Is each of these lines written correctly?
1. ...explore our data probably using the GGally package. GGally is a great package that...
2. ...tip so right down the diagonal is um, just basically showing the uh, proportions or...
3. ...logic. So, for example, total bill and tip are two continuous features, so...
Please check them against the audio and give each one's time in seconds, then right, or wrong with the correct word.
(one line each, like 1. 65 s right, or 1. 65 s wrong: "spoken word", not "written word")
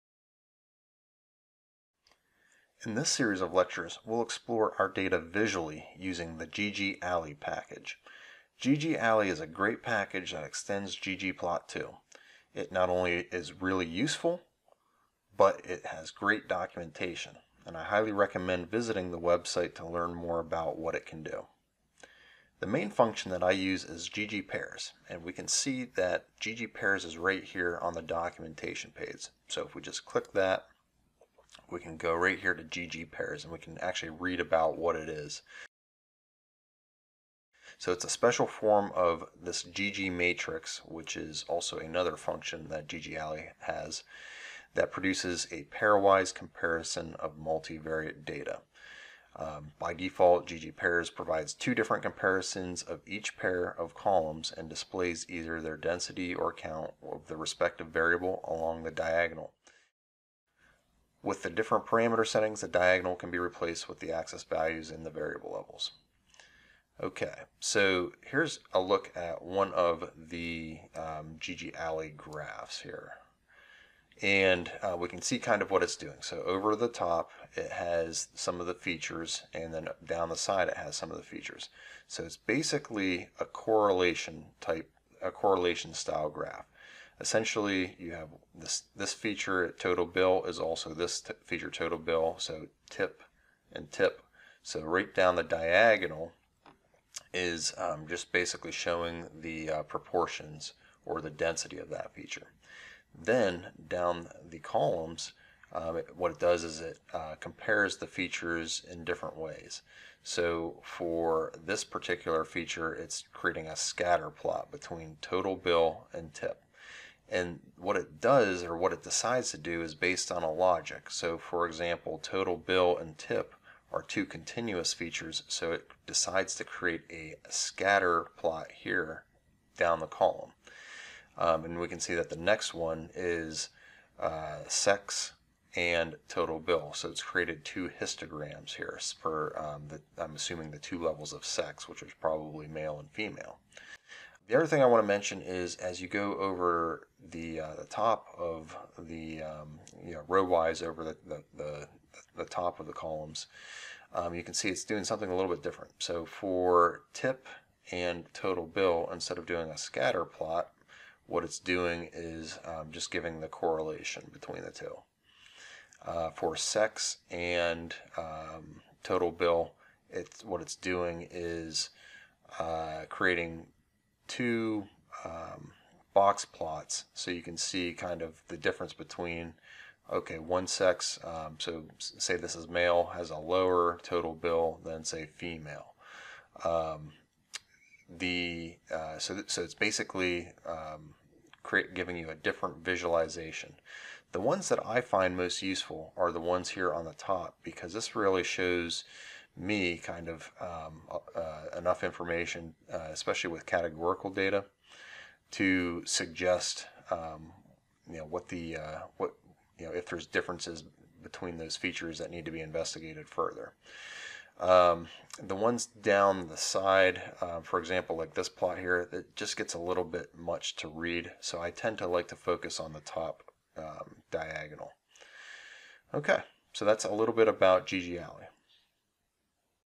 1. 4 s wrong: "visually", not "probably"
2. 93 s right
3. 120 s right.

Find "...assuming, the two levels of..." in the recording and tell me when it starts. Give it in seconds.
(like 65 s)
140 s.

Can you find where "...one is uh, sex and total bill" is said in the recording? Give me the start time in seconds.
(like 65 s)
132 s.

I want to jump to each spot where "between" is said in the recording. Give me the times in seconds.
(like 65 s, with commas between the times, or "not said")
114 s, 164 s, 178 s, 211 s.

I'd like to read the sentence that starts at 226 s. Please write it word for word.
Okay, so that's a little bit about GGally.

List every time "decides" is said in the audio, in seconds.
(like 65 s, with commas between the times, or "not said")
119 s, 126 s.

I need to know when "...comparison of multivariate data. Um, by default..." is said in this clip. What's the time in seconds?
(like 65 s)
46 s.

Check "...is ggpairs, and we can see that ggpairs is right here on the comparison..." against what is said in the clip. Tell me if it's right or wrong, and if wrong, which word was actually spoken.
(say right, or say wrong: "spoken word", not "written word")
wrong: "documentation", not "comparison".